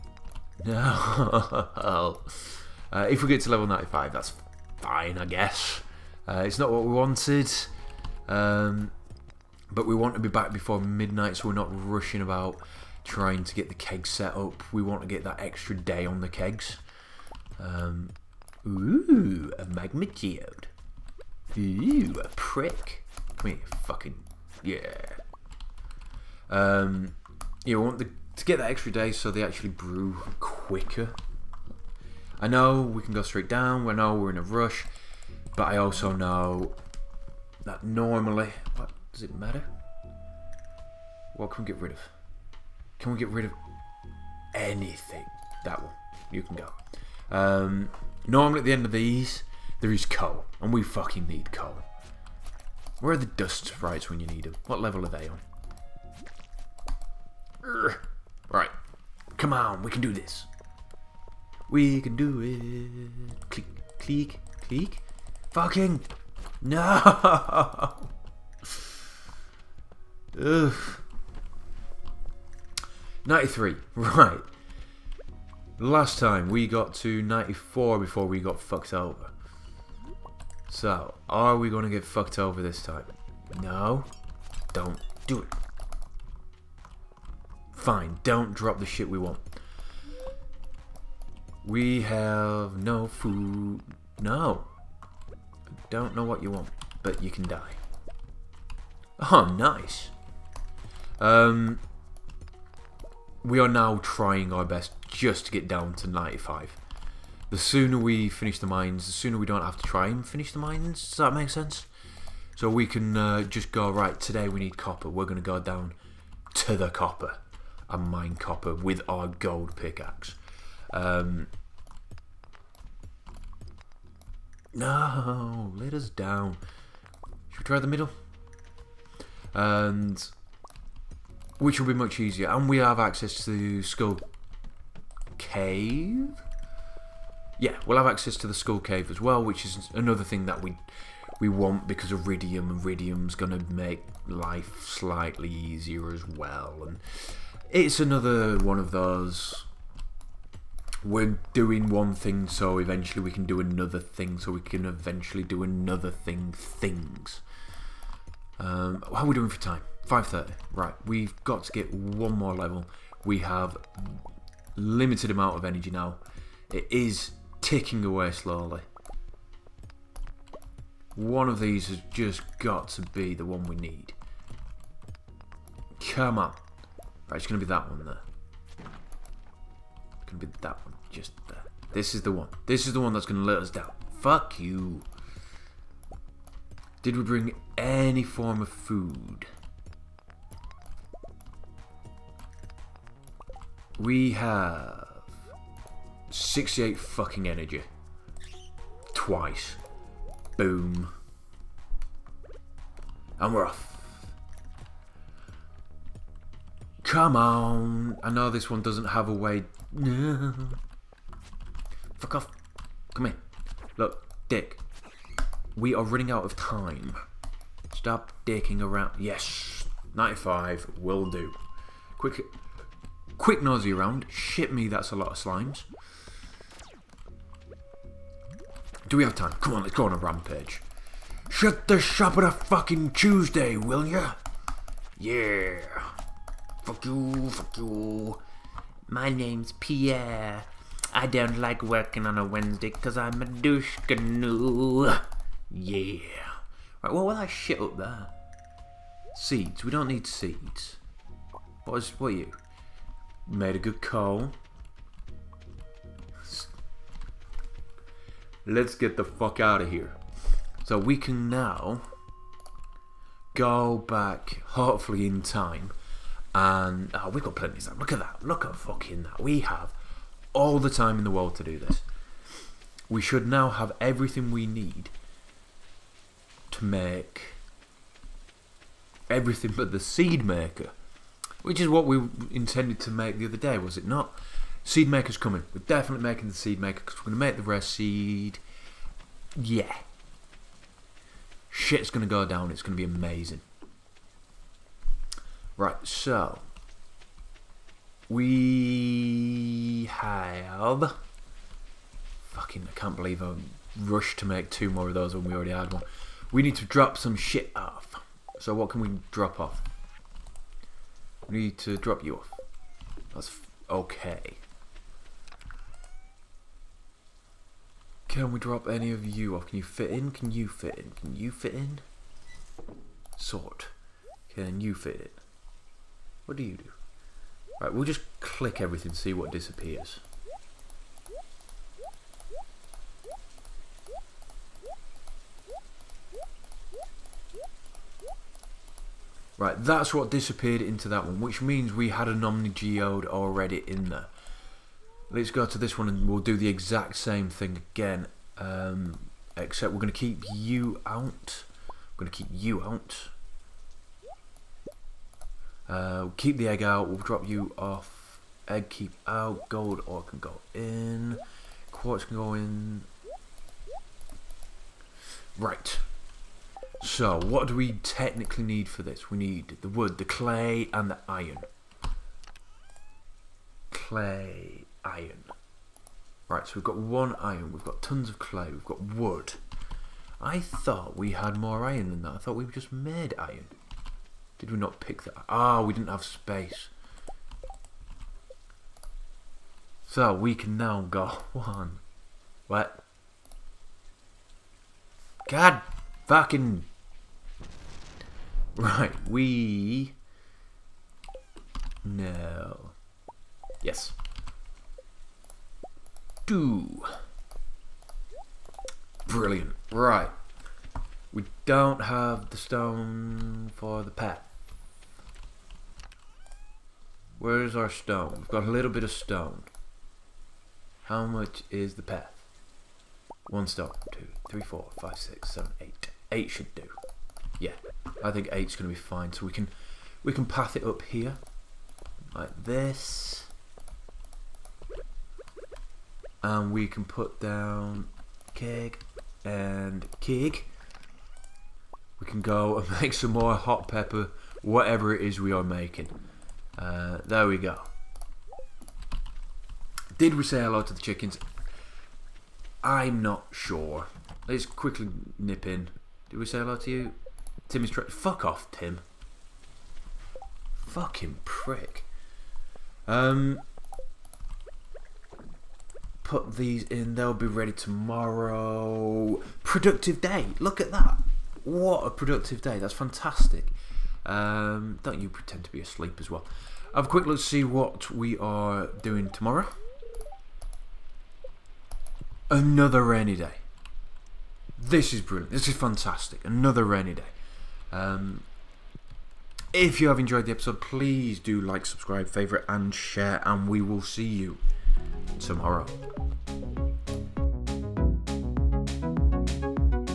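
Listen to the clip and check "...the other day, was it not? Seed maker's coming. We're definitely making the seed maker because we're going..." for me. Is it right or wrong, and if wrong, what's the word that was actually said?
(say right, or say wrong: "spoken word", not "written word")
right.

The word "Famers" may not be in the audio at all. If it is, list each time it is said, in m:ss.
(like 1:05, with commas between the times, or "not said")
not said.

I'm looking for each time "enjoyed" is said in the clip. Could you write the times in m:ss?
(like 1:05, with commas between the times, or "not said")
8:10.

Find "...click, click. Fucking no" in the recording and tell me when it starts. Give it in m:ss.
1:03.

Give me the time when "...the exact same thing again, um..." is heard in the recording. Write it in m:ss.
5:46.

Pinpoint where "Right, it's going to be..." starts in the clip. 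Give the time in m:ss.
2:57.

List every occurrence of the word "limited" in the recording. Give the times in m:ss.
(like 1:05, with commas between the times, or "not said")
2:44.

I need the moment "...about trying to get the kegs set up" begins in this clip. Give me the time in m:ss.
0:12.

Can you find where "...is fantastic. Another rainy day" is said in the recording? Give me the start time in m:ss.
8:05.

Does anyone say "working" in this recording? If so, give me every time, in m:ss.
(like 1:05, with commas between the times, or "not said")
4:01.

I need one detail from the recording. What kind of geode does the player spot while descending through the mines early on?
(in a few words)
Magma geode.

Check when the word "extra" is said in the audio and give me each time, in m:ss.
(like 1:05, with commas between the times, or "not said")
0:15, 0:28.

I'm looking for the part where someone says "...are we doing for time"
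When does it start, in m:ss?
2:39.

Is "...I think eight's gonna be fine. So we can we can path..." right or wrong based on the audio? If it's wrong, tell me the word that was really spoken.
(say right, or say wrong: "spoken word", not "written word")
right.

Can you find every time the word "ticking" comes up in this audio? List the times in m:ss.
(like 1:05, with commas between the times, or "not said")
2:47.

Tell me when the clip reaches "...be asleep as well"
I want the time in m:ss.
7:55.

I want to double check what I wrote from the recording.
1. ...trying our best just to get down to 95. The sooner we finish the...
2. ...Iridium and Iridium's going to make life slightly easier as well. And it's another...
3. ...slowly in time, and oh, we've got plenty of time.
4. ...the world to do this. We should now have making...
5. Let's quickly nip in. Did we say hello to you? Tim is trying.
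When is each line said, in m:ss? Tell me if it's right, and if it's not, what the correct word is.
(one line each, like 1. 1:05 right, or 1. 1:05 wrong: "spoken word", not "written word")
1. 1:44 right
2. 2:22 right
3. 4:24 wrong: "hopefully", not "slowly"
4. 4:31 wrong: "everything", not "making"
5. 7:34 right.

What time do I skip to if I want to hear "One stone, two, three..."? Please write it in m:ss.
7:03.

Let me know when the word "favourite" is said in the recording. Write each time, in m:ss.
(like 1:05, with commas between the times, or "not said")
8:12.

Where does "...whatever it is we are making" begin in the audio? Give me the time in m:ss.
7:24.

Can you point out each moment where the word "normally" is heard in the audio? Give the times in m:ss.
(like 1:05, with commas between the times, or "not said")
0:37, 0:48.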